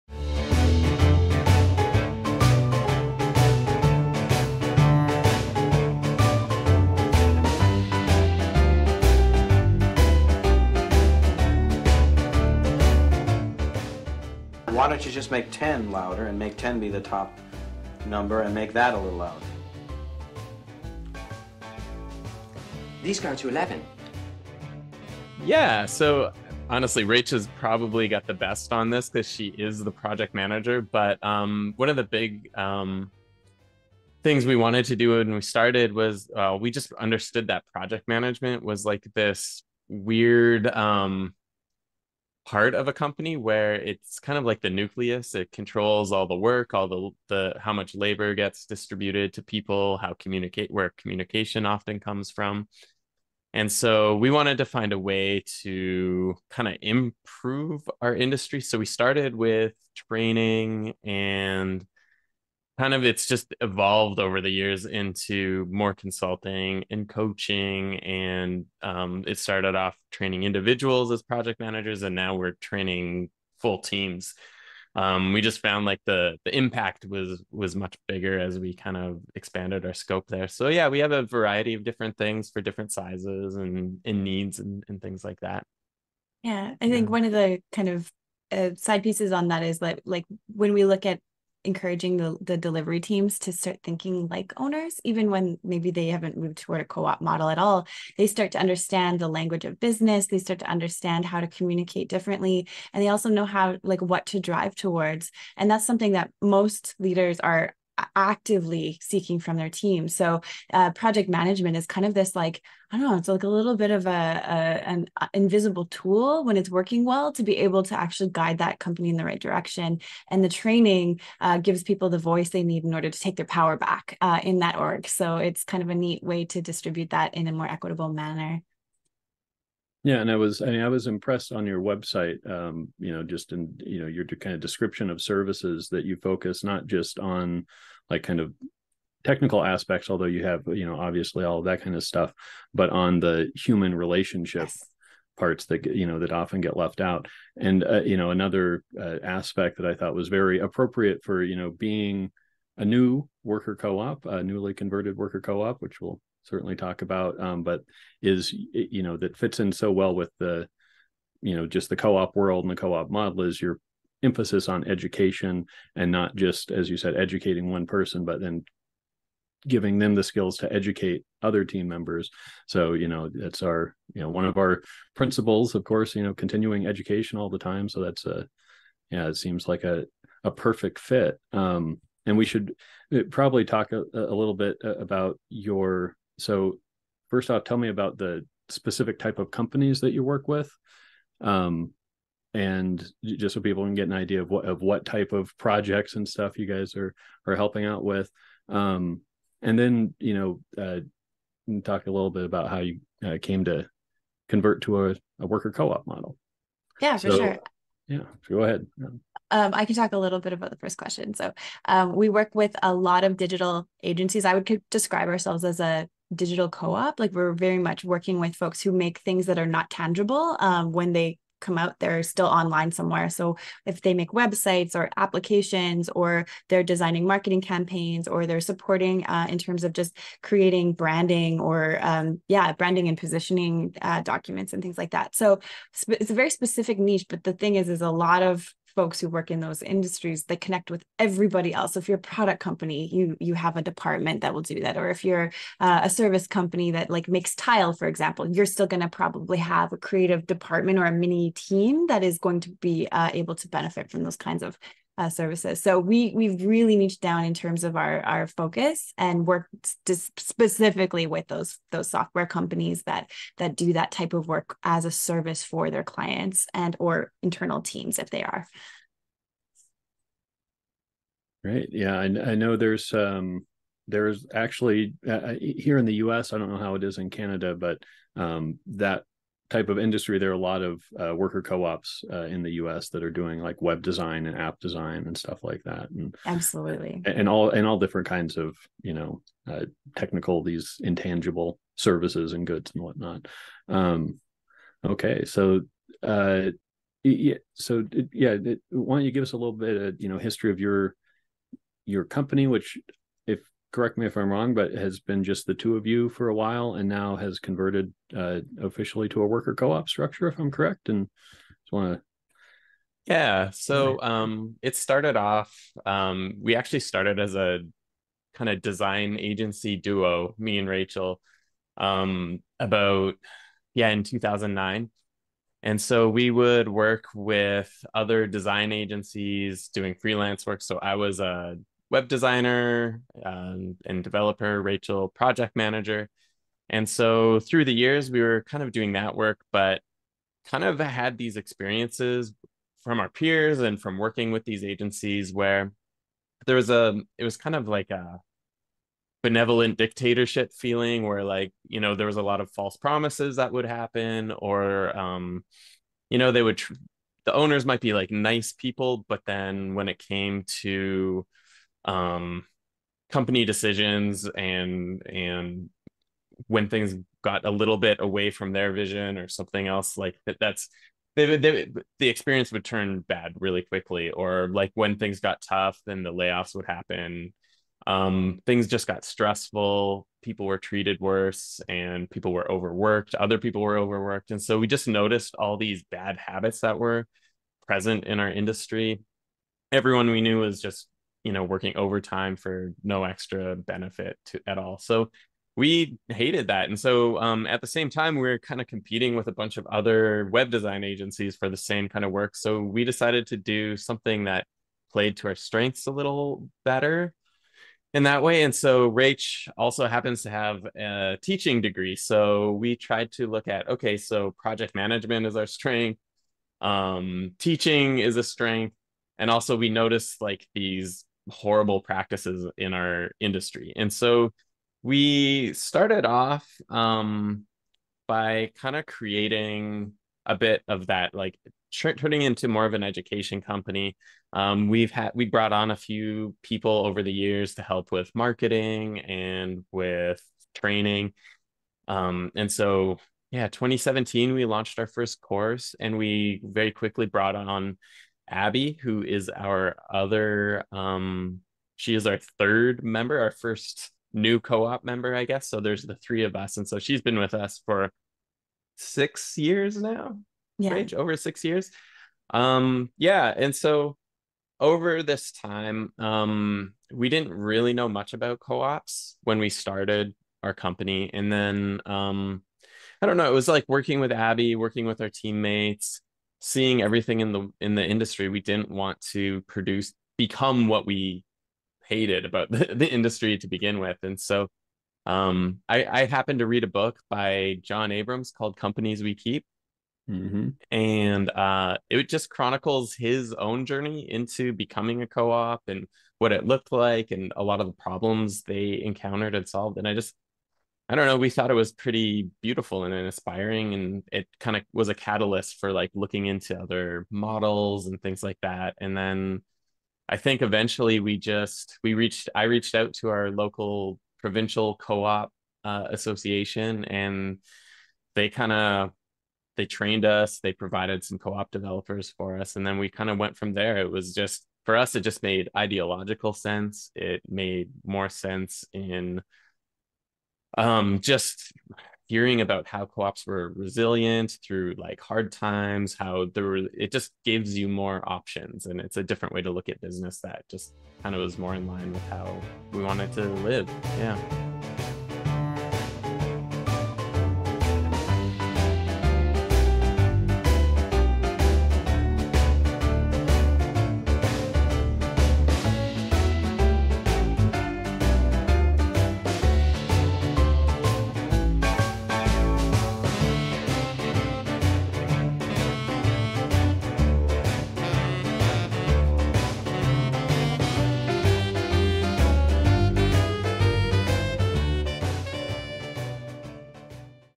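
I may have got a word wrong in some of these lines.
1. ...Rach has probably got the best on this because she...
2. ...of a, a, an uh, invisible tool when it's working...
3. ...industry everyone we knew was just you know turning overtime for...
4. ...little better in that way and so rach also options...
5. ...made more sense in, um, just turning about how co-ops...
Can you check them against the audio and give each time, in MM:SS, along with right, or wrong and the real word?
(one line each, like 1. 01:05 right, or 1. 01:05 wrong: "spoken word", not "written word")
1. 00:27 right
2. 01:53 right
3. 06:28 wrong: "working", not "turning"
4. 06:46 wrong: "happens", not "options"
5. 08:47 wrong: "hearing", not "turning".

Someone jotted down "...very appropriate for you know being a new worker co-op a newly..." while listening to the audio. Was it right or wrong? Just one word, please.
right.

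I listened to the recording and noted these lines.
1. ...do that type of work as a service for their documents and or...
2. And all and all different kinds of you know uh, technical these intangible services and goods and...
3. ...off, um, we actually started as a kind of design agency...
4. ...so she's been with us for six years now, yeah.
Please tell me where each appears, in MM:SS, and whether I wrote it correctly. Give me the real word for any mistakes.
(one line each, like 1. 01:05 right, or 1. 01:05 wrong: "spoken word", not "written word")
1. 04:23 wrong: "clients", not "documents"
2. 04:47 right
3. 05:15 right
4. 07:36 right.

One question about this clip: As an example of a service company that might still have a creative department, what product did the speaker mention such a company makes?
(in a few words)
tile.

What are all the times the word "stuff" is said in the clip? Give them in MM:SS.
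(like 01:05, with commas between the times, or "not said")
02:22, 03:16, 04:45.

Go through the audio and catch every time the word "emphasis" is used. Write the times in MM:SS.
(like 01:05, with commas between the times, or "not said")
02:44.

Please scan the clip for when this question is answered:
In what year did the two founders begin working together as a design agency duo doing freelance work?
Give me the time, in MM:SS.
05:24.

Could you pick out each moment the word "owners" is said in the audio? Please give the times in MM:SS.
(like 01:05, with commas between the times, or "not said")
01:34, 05:57.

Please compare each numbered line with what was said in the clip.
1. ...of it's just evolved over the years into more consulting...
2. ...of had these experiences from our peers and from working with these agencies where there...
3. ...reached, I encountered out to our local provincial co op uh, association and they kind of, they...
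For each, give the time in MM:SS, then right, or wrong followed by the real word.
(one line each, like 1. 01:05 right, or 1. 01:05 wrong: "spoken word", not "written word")
1. 01:02 right
2. 05:40 right
3. 08:32 wrong: "reached", not "encountered".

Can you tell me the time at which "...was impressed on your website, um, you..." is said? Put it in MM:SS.
02:10.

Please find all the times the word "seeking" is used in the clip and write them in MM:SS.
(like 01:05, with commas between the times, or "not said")
01:49.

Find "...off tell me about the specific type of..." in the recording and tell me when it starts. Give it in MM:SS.
03:07.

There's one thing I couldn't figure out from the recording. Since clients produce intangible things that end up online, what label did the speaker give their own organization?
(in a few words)
digital co-op.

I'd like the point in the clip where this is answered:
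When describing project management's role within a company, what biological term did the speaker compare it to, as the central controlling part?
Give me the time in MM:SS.
00:44.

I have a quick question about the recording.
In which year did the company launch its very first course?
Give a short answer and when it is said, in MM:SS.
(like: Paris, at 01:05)
2017, at 07:23.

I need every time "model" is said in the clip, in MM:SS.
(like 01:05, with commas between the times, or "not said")
01:37, 02:43, 03:26, 08:27.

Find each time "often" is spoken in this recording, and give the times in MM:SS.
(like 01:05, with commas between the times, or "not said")
00:51, 02:26.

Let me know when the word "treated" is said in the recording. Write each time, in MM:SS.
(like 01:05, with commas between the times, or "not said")
06:20.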